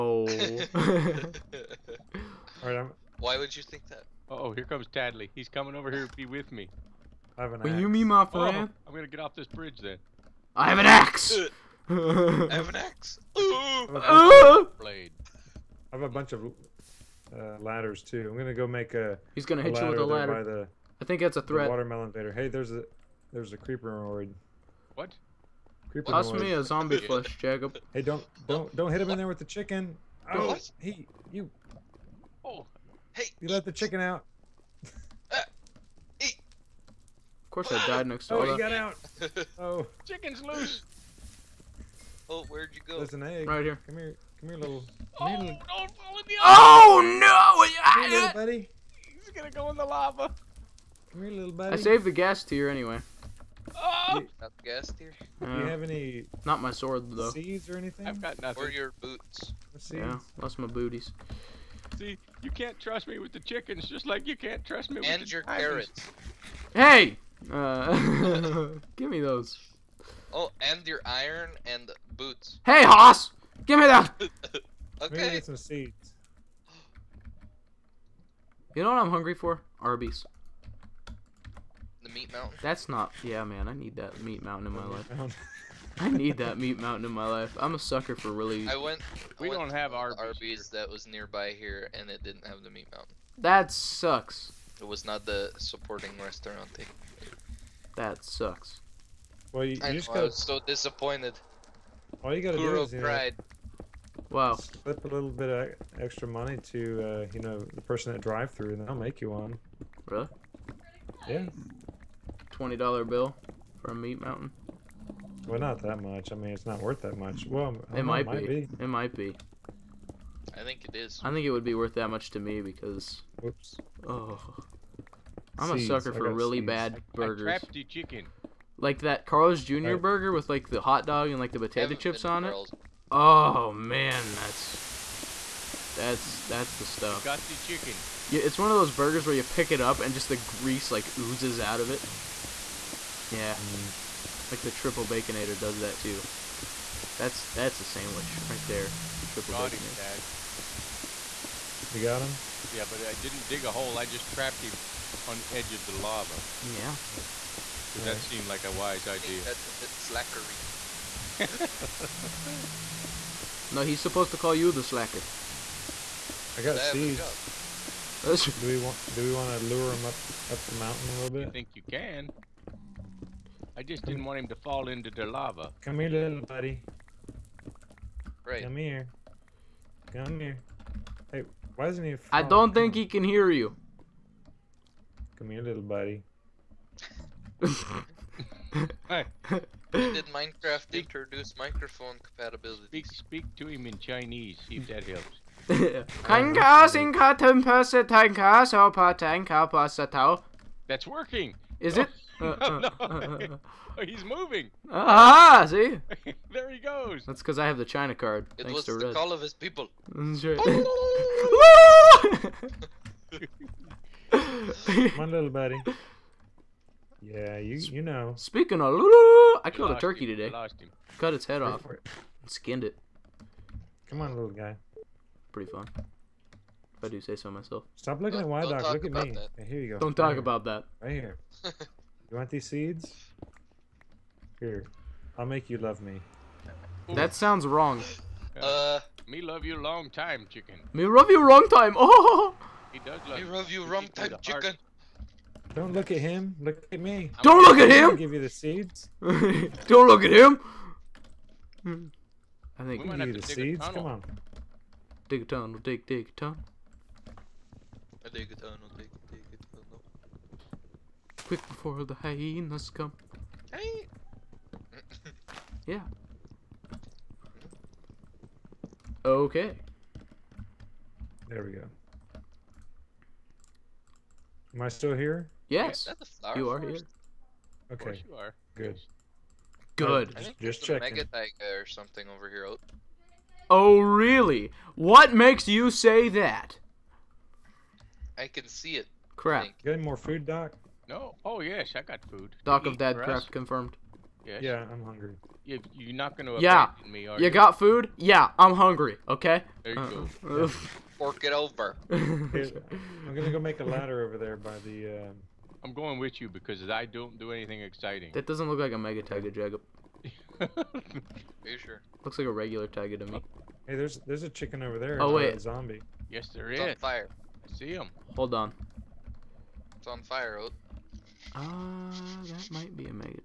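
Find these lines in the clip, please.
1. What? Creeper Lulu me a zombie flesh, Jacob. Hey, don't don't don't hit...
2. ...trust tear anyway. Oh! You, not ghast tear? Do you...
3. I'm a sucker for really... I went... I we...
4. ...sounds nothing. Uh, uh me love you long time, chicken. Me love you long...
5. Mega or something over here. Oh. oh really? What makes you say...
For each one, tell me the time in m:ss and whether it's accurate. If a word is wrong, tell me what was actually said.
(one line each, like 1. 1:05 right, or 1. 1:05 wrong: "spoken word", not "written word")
1. 0:24 wrong: "Toss", not "Lulu"
2. 0:52 wrong: "ghast", not "trust"
3. 1:27 right
4. 3:57 wrong: "wrong", not "nothing"
5. 4:41 right.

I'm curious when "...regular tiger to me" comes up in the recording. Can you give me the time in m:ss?
5:12.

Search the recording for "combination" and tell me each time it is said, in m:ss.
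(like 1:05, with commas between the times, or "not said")
not said.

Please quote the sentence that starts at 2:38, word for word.
That seemed like a wise idea.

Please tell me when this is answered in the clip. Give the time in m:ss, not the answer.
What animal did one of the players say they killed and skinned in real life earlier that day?
3:39.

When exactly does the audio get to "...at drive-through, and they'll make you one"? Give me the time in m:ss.
1:48.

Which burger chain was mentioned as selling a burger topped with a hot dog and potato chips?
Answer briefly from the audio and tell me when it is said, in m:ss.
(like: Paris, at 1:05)
Carl's Jr., at 2:09.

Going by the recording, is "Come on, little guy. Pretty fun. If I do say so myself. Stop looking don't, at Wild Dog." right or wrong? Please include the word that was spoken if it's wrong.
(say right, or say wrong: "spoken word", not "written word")
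right.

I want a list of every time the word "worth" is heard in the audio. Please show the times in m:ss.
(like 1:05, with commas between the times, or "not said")
1:56, 2:01.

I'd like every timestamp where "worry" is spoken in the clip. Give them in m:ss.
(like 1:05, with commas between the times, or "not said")
not said.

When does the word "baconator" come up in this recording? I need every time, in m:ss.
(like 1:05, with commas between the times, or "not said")
2:25, 2:29.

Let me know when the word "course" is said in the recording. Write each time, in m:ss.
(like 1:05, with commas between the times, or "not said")
0:37, 4:37.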